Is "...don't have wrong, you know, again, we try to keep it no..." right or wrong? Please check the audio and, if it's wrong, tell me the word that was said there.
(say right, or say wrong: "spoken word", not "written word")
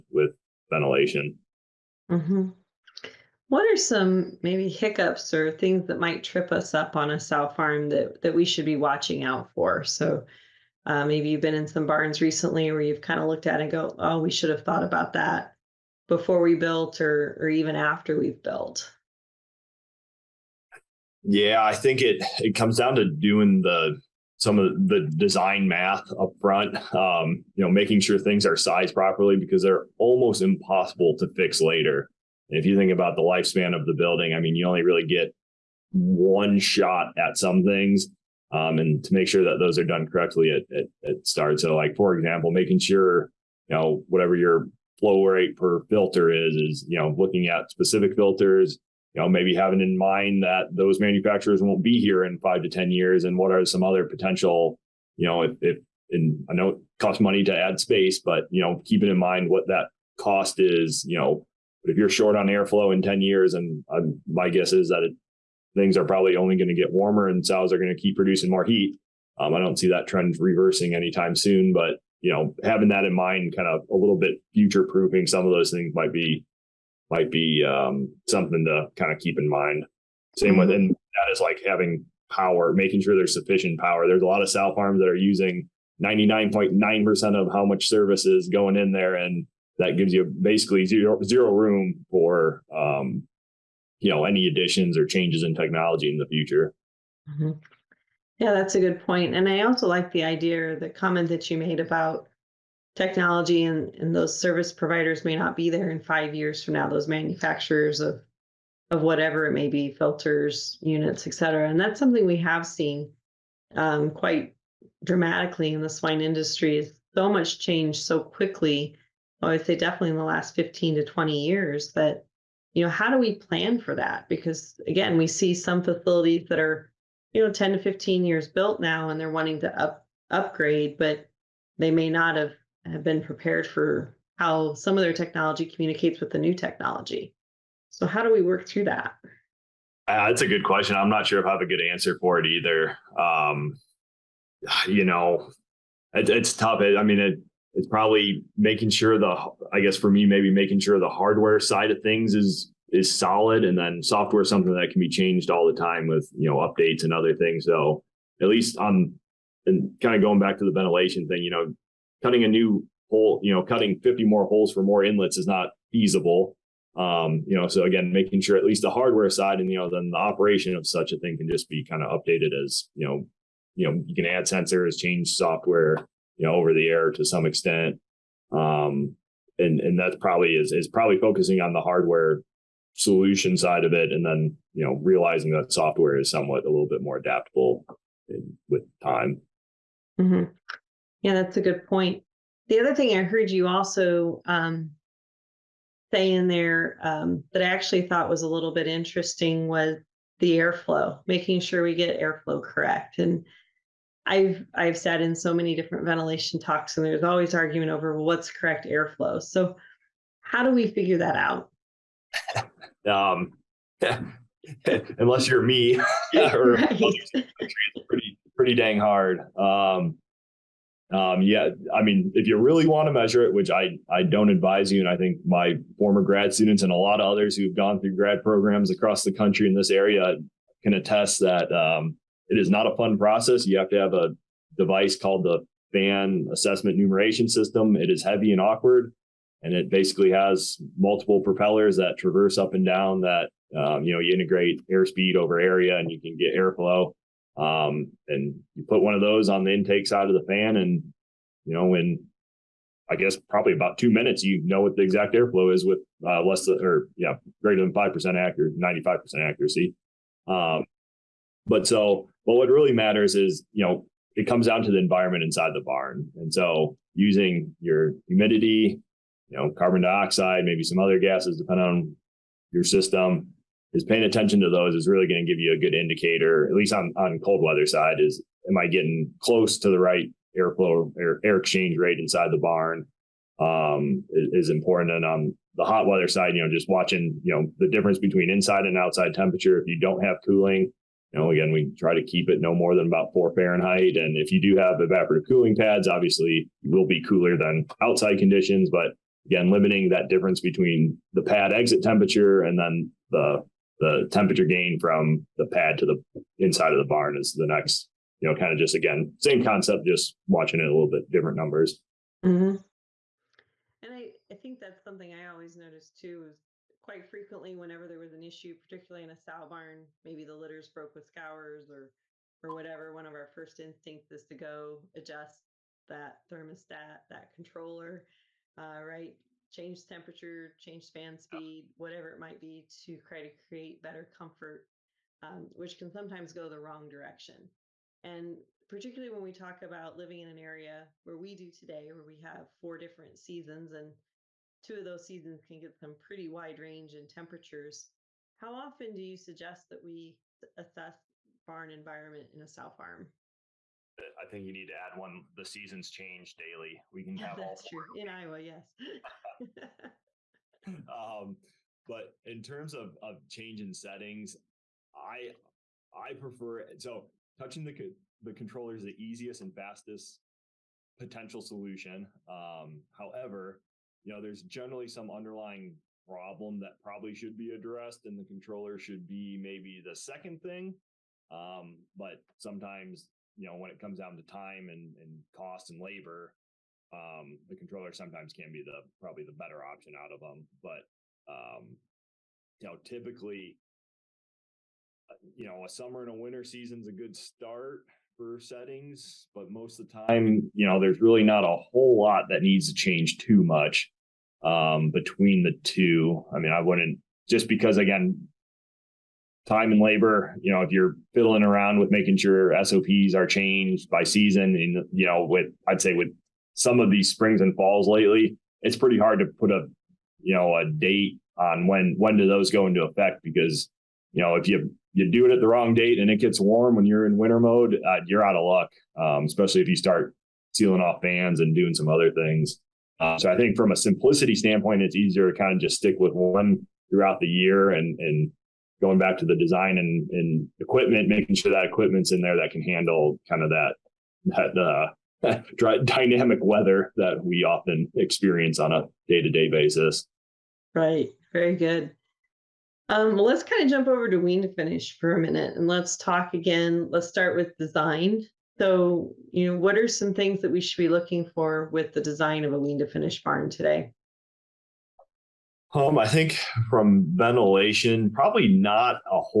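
wrong: "cooling", not "wrong".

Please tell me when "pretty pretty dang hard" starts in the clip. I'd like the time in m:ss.
3:38.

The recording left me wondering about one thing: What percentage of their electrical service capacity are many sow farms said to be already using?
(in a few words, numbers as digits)
99.9%.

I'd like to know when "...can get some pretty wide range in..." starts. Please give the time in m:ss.
5:45.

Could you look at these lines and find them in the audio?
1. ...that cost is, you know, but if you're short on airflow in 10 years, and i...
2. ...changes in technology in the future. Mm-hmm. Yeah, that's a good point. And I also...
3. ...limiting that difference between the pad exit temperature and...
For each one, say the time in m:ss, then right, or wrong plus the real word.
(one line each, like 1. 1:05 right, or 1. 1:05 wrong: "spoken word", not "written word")
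1. 0:59 right
2. 1:35 right
3. 4:59 right.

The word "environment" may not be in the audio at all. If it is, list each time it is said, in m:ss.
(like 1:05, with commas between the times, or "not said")
4:24, 5:51.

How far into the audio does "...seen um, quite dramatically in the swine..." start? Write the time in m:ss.
1:52.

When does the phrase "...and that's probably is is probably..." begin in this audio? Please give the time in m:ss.
2:59.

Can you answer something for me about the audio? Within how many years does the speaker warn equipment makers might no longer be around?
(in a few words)
5 to 10 years.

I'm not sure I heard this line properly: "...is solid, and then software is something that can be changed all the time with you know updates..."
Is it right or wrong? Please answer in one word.
right.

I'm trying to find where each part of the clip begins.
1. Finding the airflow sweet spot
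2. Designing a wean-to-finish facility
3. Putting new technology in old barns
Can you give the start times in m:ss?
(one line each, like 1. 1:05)
1. 3:12
2. 7:32
3. 1:38.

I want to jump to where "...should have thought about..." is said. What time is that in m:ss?
0:14.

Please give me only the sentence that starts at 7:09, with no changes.
Um, especially if you start sealing off fans and doing some other things.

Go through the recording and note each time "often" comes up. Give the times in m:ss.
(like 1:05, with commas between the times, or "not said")
5:48, 7:27.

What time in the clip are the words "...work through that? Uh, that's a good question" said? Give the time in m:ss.
2:18.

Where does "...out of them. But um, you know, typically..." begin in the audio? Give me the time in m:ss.
6:30.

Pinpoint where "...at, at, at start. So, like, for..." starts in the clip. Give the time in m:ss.
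0:40.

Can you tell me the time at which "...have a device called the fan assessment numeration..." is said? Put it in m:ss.
3:53.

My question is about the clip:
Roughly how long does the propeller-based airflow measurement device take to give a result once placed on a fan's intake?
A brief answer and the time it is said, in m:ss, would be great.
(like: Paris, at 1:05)
2 minutes, at 4:13.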